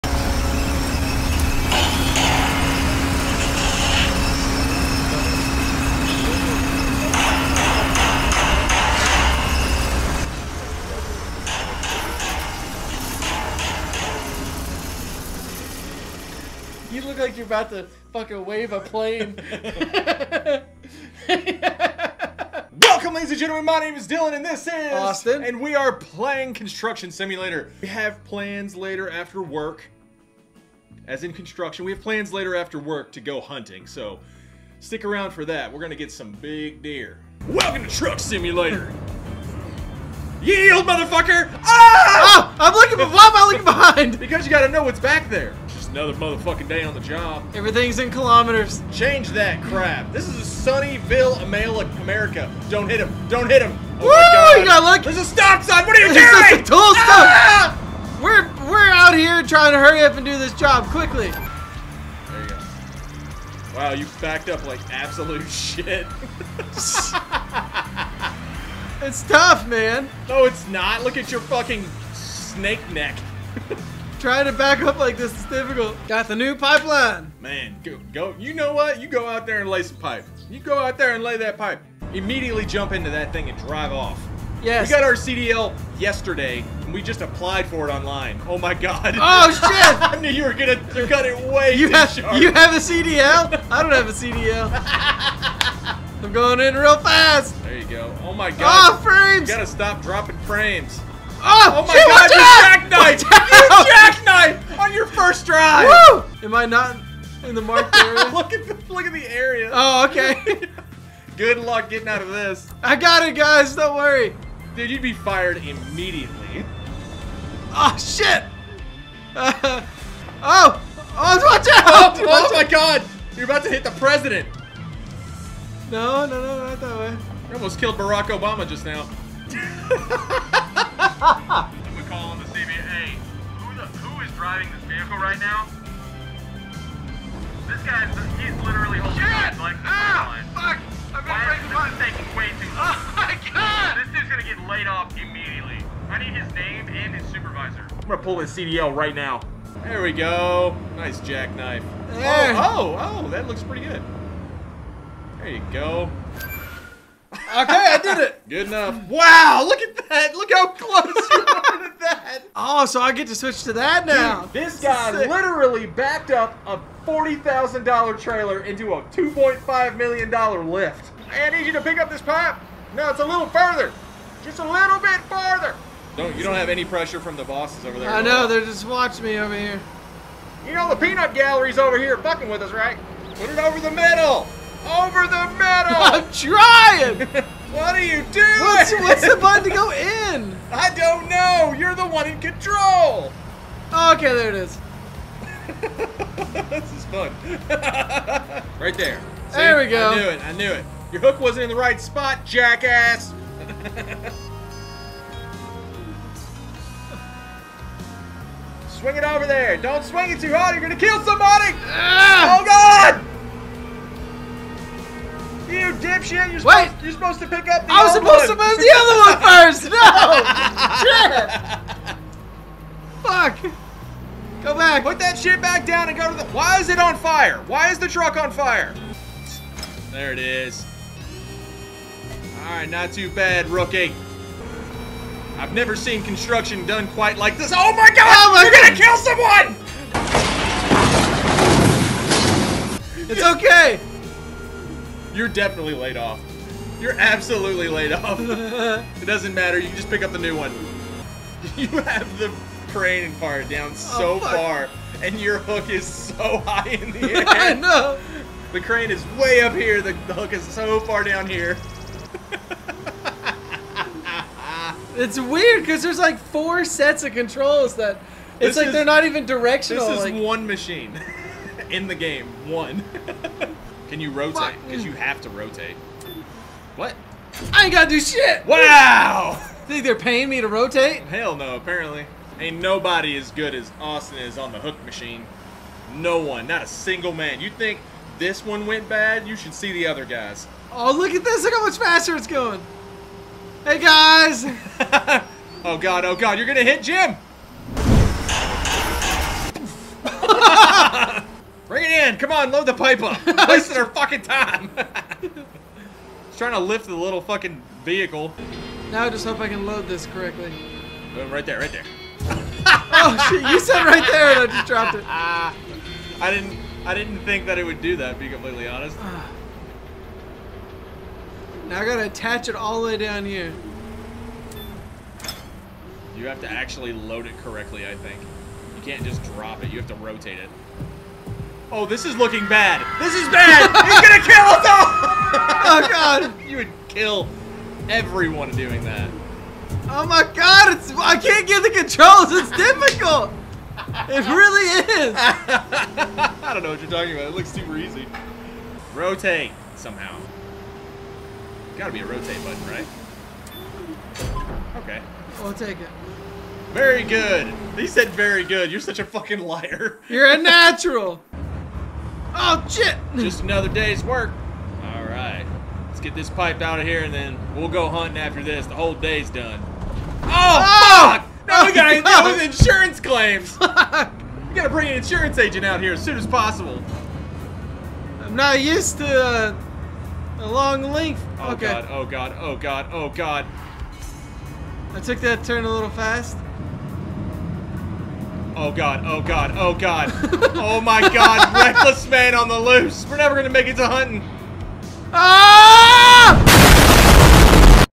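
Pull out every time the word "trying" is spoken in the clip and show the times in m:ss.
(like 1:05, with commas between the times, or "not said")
0:59, 1:14, 3:06, 5:06.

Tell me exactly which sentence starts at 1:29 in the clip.
I knew you were gonna cut it way you have, sharp.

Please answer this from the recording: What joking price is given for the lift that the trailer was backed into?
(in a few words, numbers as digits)
$2.5 million.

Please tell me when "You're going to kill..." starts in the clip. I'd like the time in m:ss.
3:30.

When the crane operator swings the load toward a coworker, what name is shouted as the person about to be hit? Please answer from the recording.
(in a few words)
Jim.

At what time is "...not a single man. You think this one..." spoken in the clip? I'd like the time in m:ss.
4:46.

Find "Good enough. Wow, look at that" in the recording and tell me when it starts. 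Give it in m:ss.
2:38.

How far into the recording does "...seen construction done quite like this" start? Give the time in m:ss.
3:55.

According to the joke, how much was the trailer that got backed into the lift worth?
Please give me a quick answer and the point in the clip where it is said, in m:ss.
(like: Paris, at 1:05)
$40,000, at 2:47.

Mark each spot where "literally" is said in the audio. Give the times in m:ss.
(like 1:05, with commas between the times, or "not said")
2:18, 2:45.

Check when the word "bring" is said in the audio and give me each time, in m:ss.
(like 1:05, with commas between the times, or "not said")
5:01, 6:14.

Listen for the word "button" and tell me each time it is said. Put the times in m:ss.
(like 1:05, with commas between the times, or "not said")
3:09, 5:52.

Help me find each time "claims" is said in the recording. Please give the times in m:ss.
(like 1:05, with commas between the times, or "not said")
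6:13.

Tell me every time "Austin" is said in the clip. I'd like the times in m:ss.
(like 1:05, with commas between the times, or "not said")
0:24, 4:43.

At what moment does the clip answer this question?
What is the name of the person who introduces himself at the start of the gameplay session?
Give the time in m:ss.
0:24.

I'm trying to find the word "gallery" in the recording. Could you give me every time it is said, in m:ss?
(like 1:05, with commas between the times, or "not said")
3:01.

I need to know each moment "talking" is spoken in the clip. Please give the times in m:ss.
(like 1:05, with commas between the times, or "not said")
5:47.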